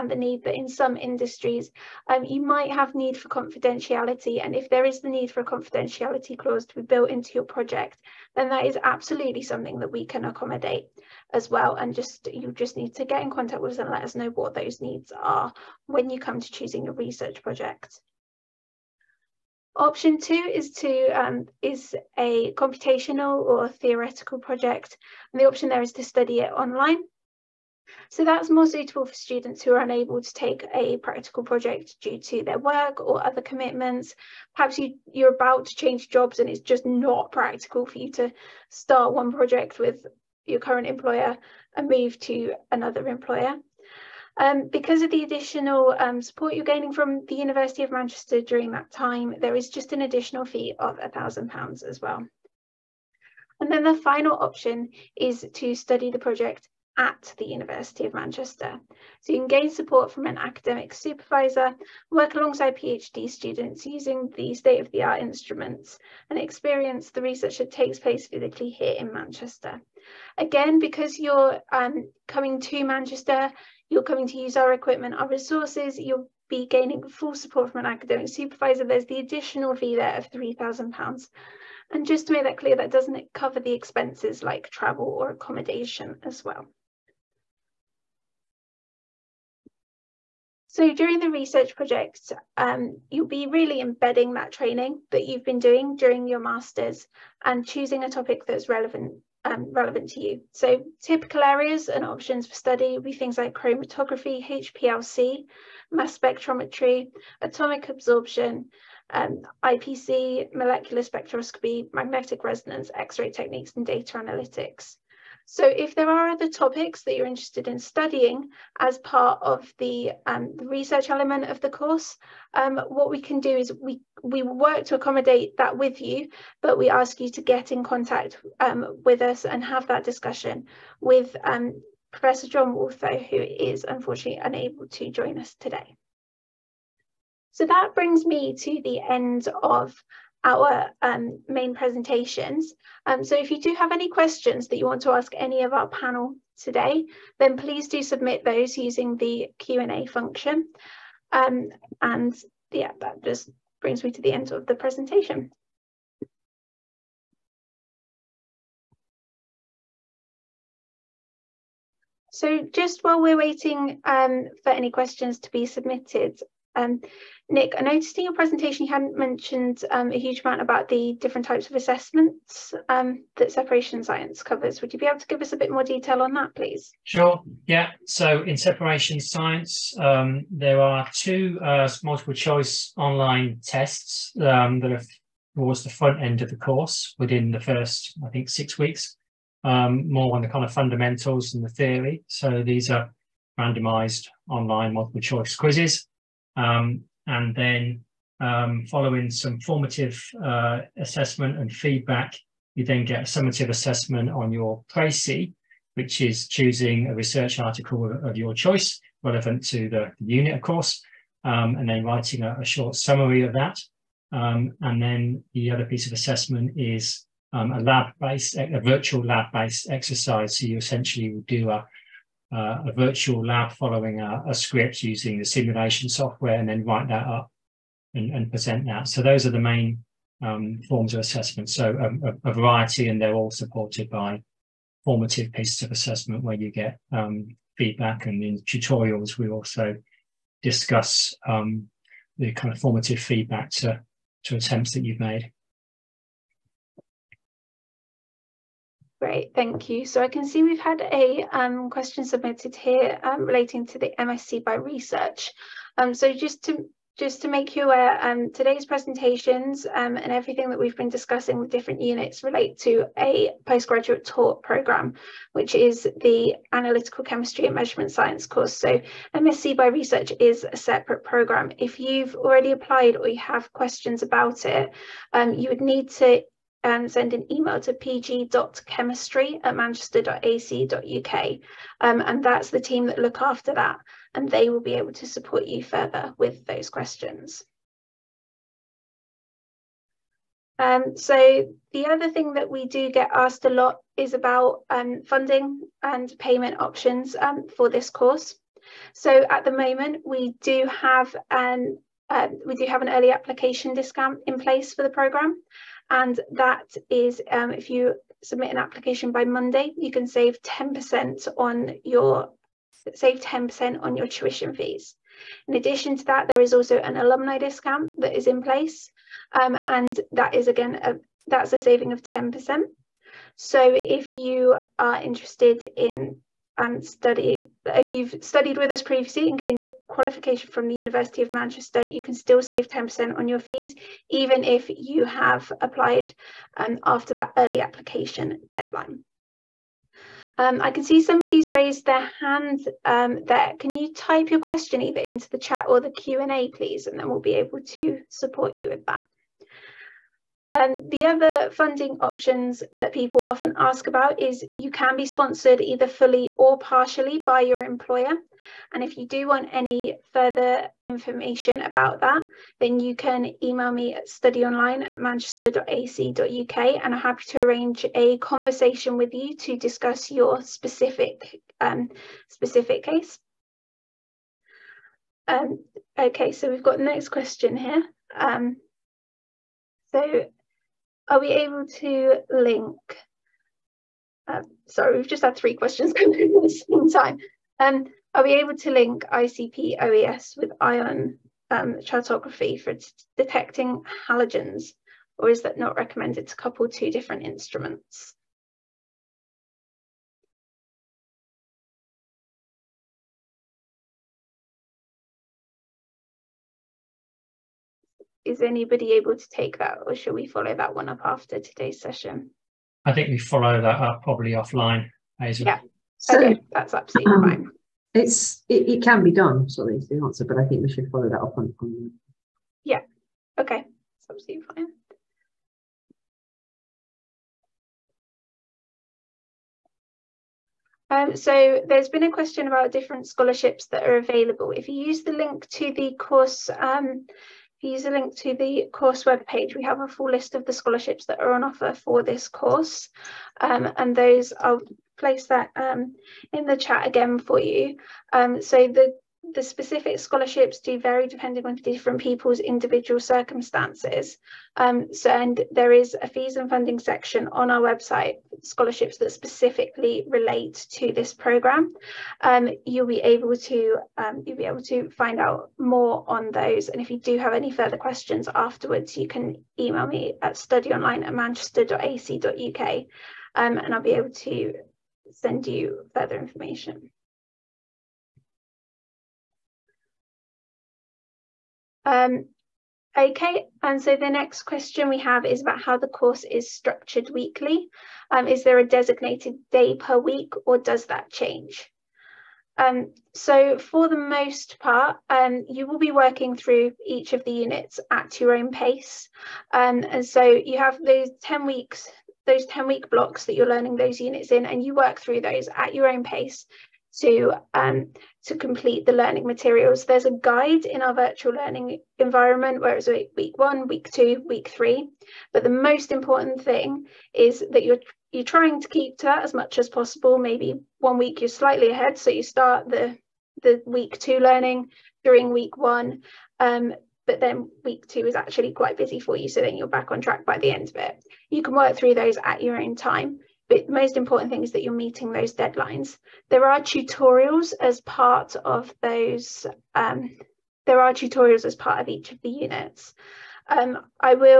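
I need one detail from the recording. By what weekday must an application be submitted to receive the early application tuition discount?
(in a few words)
Monday.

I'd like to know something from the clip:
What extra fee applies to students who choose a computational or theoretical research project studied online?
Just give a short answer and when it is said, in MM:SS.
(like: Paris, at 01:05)
£1,000, at 00:50.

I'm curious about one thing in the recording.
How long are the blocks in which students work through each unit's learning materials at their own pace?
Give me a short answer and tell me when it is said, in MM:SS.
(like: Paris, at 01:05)
10 weeks, at 08:22.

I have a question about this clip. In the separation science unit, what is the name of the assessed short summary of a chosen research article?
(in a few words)
précis.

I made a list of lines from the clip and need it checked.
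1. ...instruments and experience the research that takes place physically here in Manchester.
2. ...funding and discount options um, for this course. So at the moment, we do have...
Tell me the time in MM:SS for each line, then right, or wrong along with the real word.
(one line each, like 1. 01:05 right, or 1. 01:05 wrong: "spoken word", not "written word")
1. 01:05 right
2. 04:55 wrong: "payment", not "discount".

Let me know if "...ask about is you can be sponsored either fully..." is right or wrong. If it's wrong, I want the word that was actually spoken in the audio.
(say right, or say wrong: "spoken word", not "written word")
right.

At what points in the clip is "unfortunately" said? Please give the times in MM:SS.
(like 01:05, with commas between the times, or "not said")
02:13.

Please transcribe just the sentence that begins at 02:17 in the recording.
So that brings me to the end of our um, main presentations.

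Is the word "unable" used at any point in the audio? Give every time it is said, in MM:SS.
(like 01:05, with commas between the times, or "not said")
00:29, 02:14.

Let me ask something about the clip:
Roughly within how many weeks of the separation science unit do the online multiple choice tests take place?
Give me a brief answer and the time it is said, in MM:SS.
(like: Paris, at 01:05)
6, at 03:08.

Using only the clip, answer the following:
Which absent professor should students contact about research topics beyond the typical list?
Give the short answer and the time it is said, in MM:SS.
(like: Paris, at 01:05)
John Waltho, at 02:12.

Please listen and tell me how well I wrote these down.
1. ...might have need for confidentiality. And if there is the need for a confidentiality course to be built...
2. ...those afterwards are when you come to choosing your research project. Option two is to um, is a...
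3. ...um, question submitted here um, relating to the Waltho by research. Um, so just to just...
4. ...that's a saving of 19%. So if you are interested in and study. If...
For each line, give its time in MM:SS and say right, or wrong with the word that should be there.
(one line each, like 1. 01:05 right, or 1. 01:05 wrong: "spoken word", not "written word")
1. 00:02 wrong: "clause", not "course"
2. 00:14 wrong: "needs", not "afterwards"
3. 04:11 wrong: "MSc", not "Waltho"
4. 05:21 wrong: "10", not "19".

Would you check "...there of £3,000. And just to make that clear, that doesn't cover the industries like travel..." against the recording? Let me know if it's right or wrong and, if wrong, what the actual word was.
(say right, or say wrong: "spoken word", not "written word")
wrong: "expenses", not "industries".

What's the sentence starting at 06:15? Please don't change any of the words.
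Um, okay, so we've got the next question here.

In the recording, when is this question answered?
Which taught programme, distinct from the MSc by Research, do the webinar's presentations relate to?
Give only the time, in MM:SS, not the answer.
04:26.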